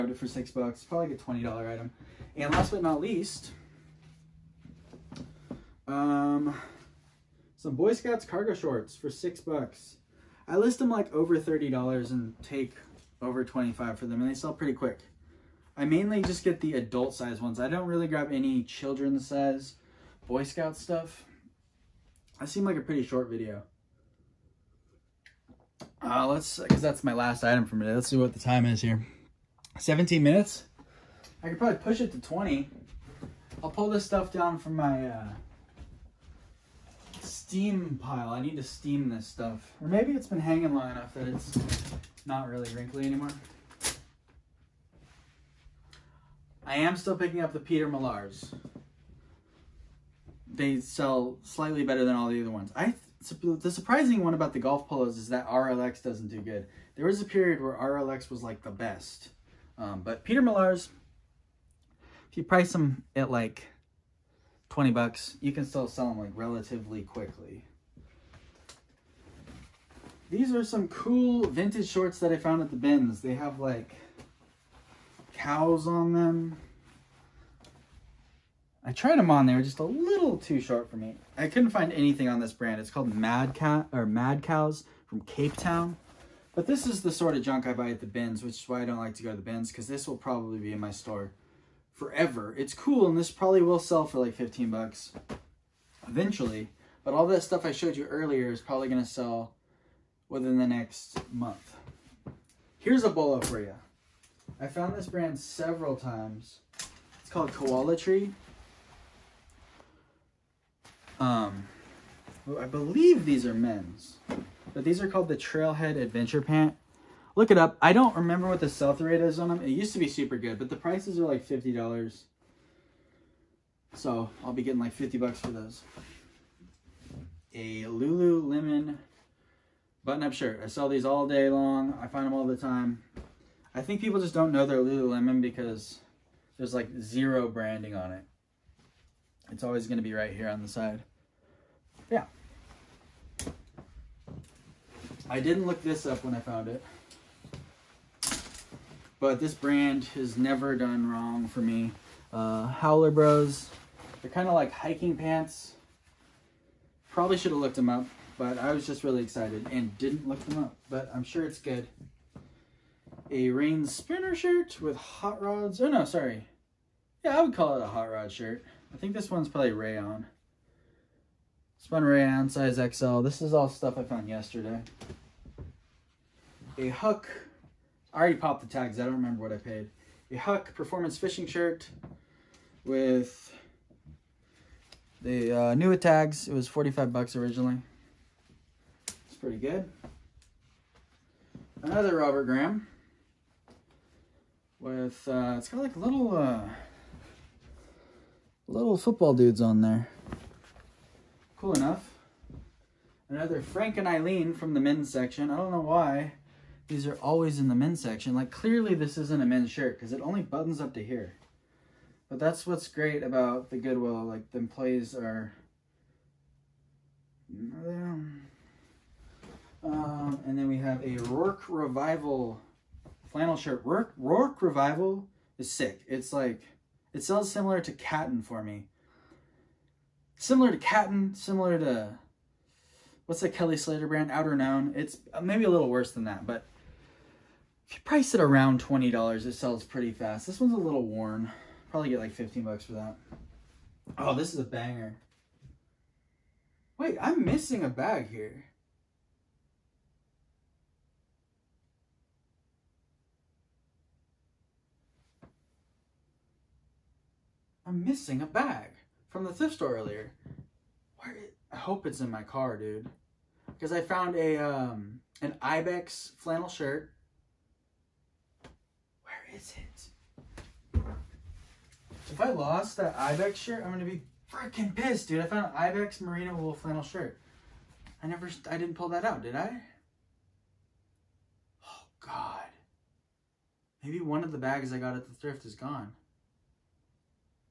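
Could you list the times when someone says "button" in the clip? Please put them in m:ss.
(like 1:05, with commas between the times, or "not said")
2:10, 3:30.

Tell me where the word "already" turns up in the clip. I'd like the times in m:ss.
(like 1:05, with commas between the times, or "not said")
2:58.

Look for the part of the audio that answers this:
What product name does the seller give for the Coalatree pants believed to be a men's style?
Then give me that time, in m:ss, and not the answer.
1:55.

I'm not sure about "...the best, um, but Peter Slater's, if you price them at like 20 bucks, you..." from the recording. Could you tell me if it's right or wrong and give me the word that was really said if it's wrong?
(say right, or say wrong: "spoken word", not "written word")
wrong: "Millar", not "Slater".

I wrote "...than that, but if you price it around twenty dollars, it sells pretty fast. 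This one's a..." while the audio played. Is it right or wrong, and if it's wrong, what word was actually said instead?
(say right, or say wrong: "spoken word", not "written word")
right.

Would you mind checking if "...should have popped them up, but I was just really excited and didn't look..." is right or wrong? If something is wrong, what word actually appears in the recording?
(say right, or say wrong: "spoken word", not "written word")
wrong: "looked", not "popped".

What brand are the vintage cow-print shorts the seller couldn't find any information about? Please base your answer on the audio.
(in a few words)
Mad Cat.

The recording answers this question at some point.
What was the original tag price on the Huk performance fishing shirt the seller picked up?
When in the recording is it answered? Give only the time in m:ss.
3:06.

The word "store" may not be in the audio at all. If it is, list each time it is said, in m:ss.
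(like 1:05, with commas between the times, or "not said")
1:30, 4:19.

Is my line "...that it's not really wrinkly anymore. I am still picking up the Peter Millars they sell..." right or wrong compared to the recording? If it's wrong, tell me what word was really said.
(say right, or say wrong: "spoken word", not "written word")
right.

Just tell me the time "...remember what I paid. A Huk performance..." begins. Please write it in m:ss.
2:59.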